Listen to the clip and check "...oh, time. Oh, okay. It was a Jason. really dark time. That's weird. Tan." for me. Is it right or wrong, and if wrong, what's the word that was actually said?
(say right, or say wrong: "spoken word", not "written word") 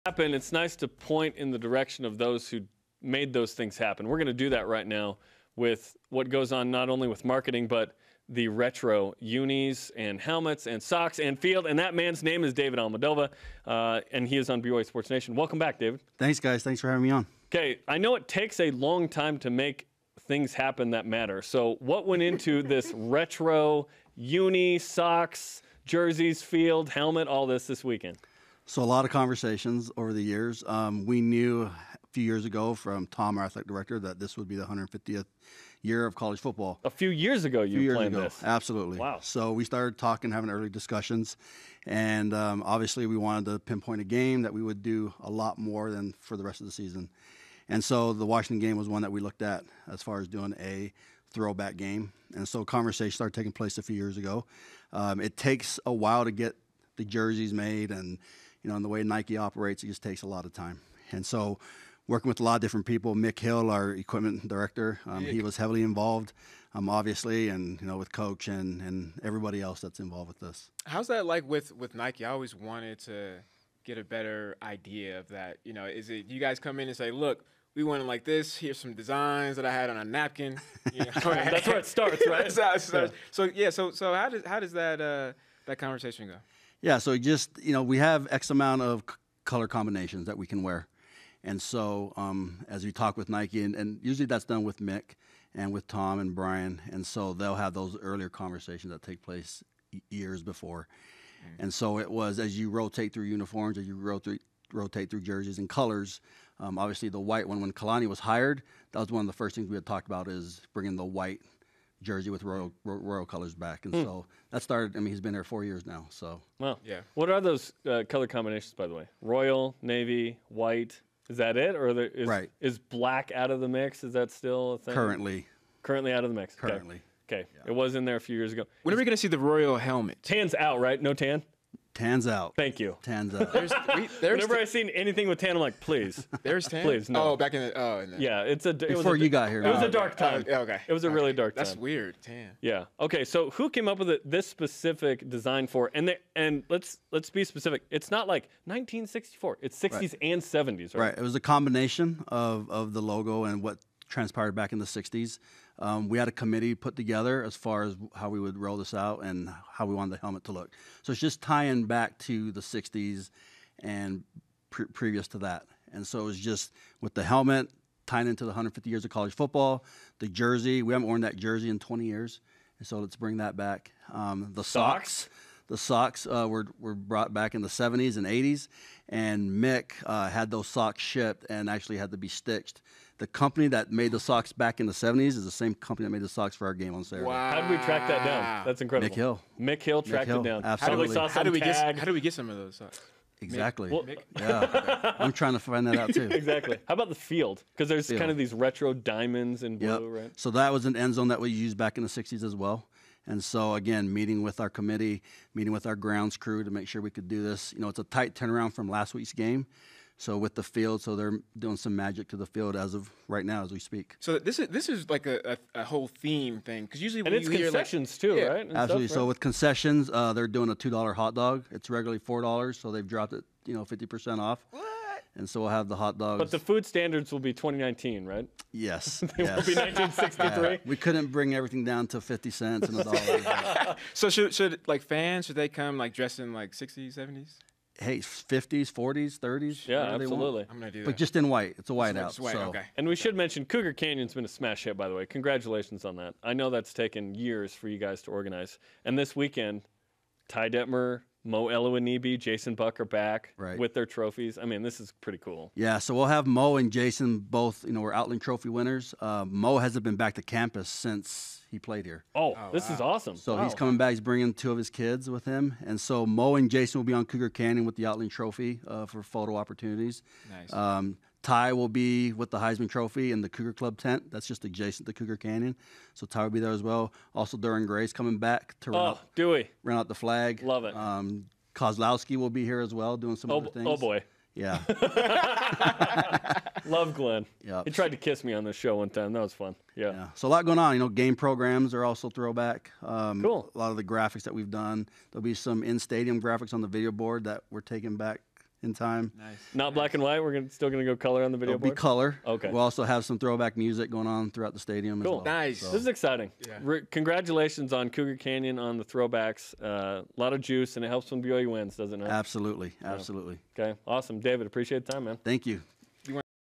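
wrong: "Okay", not "Jason".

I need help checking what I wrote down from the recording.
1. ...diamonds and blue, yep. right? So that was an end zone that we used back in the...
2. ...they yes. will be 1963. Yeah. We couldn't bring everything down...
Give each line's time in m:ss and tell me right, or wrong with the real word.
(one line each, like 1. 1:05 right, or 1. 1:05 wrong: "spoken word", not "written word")
1. 3:18 right
2. 3:49 right.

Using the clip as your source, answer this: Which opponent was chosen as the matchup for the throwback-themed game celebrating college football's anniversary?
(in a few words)
Washington.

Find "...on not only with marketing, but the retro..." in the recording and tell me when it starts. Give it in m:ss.
0:06.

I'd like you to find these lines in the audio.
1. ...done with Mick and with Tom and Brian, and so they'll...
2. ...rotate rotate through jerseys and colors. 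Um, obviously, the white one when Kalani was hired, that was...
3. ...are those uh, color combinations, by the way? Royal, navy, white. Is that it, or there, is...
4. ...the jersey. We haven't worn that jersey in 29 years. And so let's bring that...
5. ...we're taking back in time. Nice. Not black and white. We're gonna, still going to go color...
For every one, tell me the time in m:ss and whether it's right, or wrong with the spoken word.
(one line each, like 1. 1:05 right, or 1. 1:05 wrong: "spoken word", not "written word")
1. 1:34 right
2. 1:43 right
3. 1:57 right
4. 2:50 wrong: "20", not "29"
5. 4:57 right.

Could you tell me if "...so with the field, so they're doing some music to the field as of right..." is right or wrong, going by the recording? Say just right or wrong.
wrong.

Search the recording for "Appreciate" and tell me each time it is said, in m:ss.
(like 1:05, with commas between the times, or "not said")
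5:14.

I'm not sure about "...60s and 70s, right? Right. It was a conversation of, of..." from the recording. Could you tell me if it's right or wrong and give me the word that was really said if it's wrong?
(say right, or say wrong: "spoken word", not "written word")
wrong: "combination", not "conversation".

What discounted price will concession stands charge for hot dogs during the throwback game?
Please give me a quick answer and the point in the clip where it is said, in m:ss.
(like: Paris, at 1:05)
$2, at 3:40.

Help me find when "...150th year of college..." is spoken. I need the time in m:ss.
0:34.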